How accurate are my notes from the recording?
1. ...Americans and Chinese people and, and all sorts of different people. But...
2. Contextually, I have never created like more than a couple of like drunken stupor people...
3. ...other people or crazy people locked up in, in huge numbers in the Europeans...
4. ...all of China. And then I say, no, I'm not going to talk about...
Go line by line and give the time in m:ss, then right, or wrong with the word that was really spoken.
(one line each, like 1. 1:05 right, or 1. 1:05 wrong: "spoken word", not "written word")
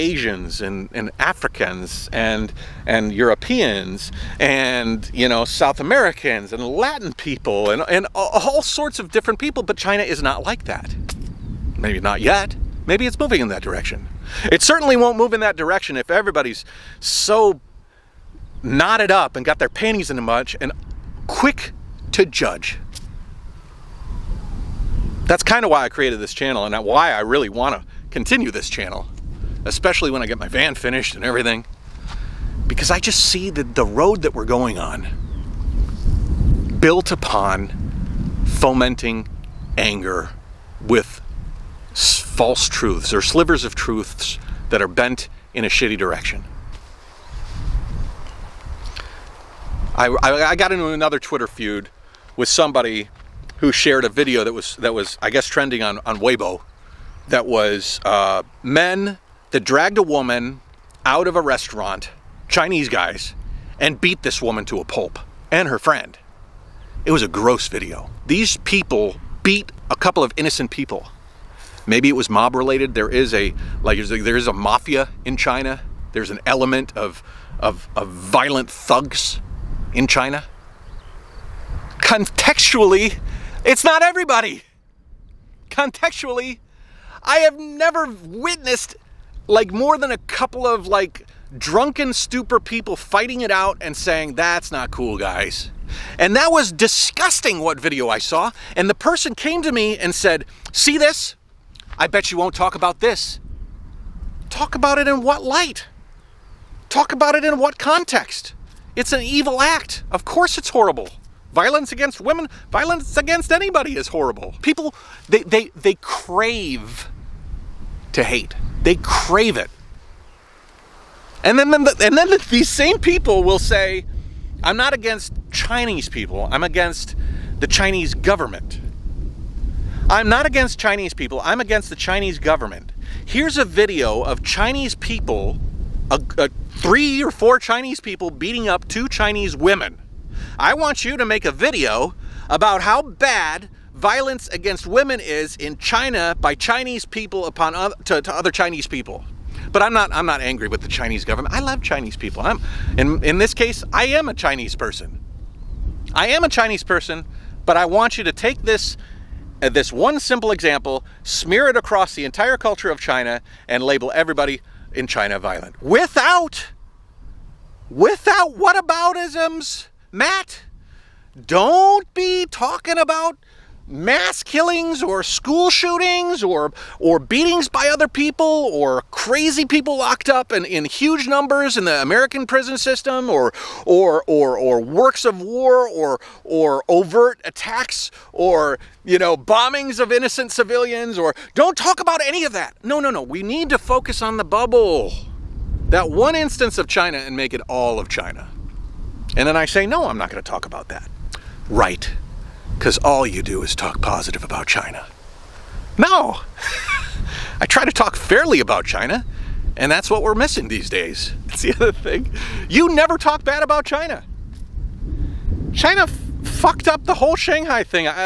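1. 0:05 wrong: "Latin", not "Chinese"
2. 1:25 wrong: "witnessed", not "created"
3. 2:57 wrong: "American", not "Europeans"
4. 3:17 right.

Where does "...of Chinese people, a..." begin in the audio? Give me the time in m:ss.
2:14.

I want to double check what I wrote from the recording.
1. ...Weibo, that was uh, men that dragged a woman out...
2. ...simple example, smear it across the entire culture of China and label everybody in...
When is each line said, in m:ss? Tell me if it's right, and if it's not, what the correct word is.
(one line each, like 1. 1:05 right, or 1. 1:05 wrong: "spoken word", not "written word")
1. 0:56 right
2. 2:40 right.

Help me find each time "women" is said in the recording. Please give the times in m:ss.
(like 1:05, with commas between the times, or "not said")
1:52, 2:19, 2:24.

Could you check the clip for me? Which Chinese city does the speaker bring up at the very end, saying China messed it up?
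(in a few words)
Shanghai.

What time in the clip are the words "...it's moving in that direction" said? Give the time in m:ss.
0:13.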